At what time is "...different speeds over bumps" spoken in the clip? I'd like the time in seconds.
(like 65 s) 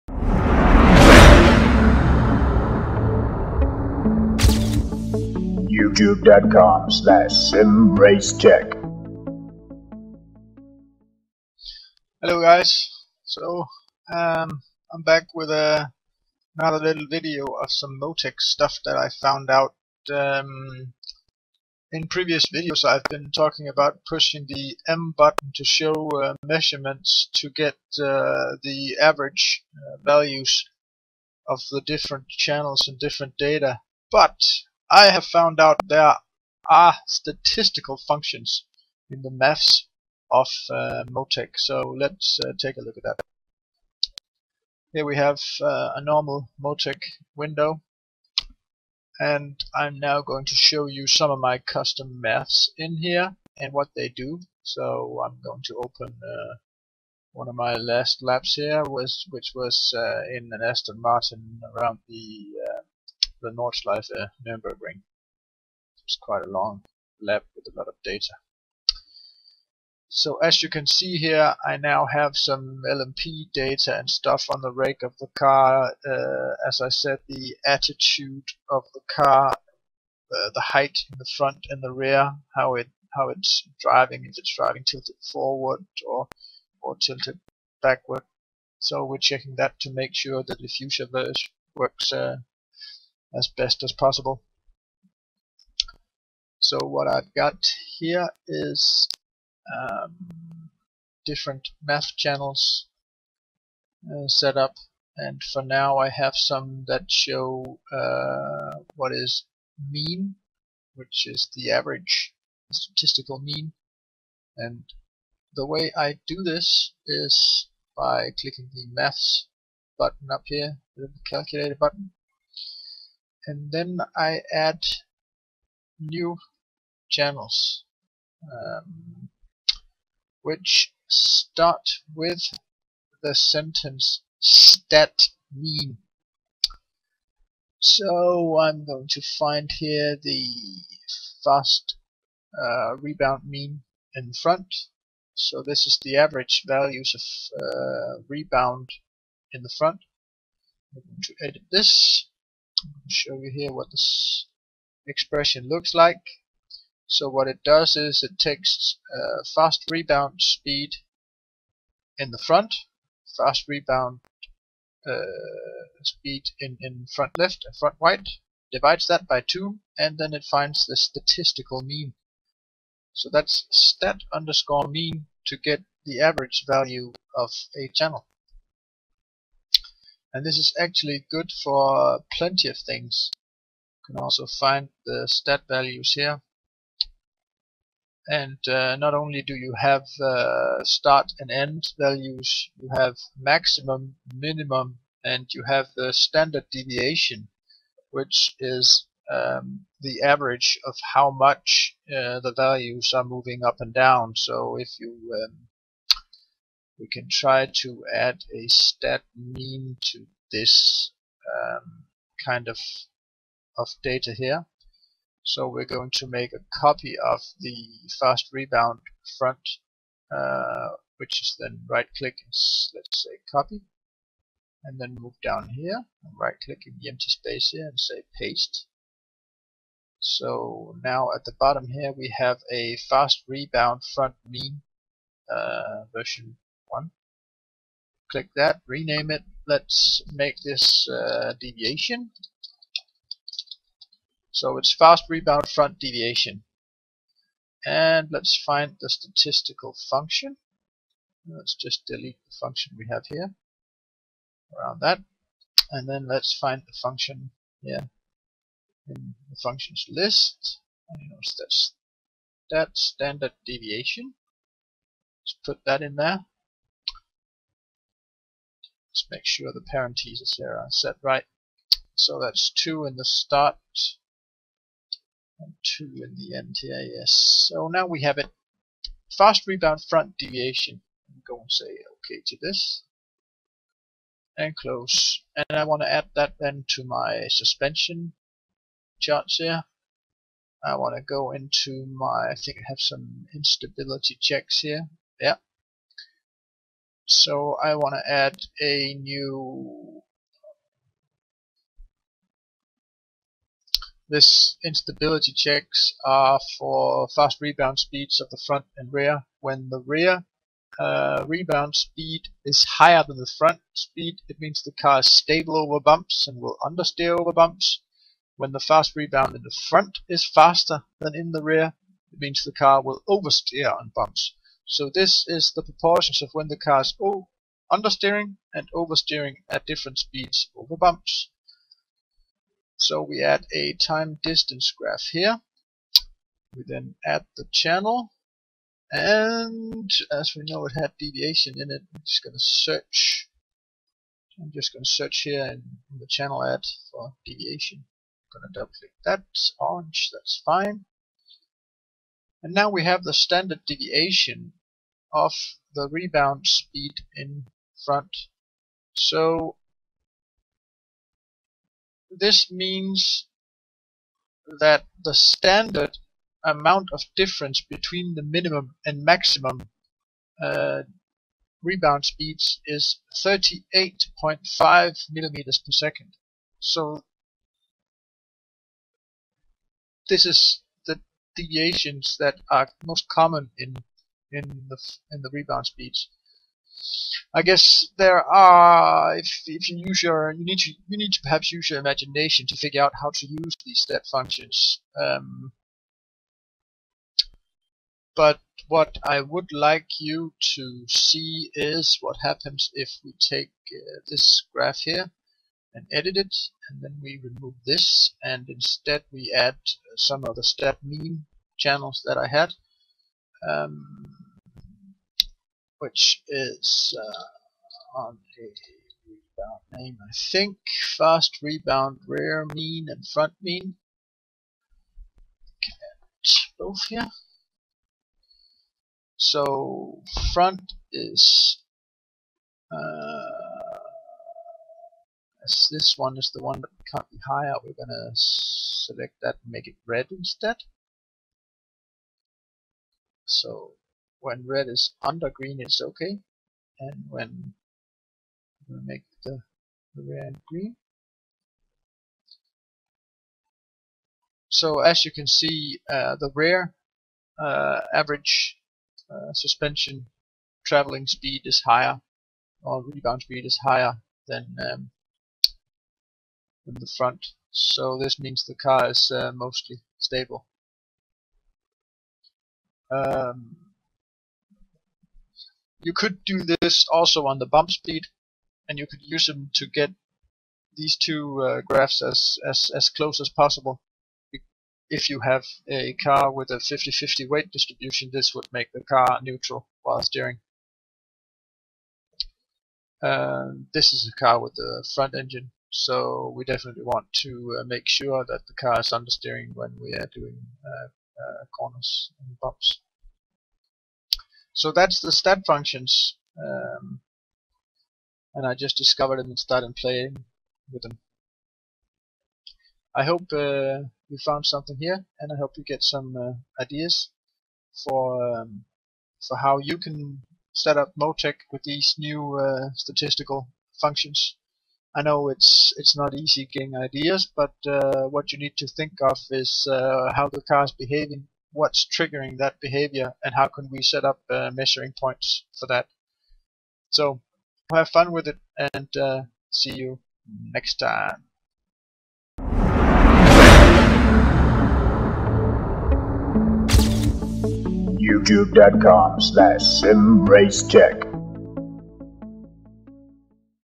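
329 s.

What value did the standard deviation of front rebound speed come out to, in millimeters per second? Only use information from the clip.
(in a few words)
38.5.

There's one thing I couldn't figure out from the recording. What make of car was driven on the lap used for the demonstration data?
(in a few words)
Aston Martin.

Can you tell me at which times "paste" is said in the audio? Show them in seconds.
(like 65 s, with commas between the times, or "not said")
228 s.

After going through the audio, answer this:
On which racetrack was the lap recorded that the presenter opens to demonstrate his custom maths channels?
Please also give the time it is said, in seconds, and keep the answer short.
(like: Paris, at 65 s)
Nordschleife Nürburgring, at 63 s.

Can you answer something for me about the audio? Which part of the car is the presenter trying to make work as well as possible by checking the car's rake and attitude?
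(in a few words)
The diffuser.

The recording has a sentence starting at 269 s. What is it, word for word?
Let's make sure the parentheses here are set right.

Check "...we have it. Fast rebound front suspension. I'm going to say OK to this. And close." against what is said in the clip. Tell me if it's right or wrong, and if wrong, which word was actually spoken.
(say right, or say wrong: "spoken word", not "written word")
wrong: "deviation", not "suspension".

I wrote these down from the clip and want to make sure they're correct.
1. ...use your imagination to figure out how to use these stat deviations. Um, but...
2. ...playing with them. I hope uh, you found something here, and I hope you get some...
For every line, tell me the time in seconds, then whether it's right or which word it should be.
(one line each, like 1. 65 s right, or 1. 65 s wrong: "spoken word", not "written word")
1. 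391 s wrong: "functions", not "deviations"
2. 509 s right.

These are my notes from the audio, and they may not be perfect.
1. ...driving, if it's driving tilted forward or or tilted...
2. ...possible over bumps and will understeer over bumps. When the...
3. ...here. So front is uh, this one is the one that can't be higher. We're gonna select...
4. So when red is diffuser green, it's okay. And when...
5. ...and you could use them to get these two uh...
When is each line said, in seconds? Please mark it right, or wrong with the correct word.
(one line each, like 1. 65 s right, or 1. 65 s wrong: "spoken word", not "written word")
1. 83 s right
2. 315 s wrong: "stable", not "possible"
3. 427 s right
4. 443 s wrong: "under", not "diffuser"
5. 478 s right.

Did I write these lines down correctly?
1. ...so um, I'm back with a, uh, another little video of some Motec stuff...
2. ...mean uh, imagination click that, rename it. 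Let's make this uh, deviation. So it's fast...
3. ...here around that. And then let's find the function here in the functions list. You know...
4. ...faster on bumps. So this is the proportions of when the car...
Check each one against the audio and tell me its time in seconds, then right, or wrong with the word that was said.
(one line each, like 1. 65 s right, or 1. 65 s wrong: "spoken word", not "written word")
1. 13 s right
2. 234 s wrong: "version", not "imagination"
3. 253 s right
4. 323 s wrong: "oversteer", not "faster".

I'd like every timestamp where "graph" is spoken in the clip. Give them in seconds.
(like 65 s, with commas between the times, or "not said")
334 s, 404 s, 481 s.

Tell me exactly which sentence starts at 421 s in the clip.
Fast rebound, rear mean, and front mean.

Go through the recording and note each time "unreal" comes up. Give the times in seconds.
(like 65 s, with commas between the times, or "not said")
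not said.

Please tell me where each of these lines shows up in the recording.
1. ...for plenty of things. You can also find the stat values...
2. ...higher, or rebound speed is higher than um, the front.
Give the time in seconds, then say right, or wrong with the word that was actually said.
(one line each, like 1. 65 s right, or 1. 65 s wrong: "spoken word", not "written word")
1. 181 s right
2. 461 s right.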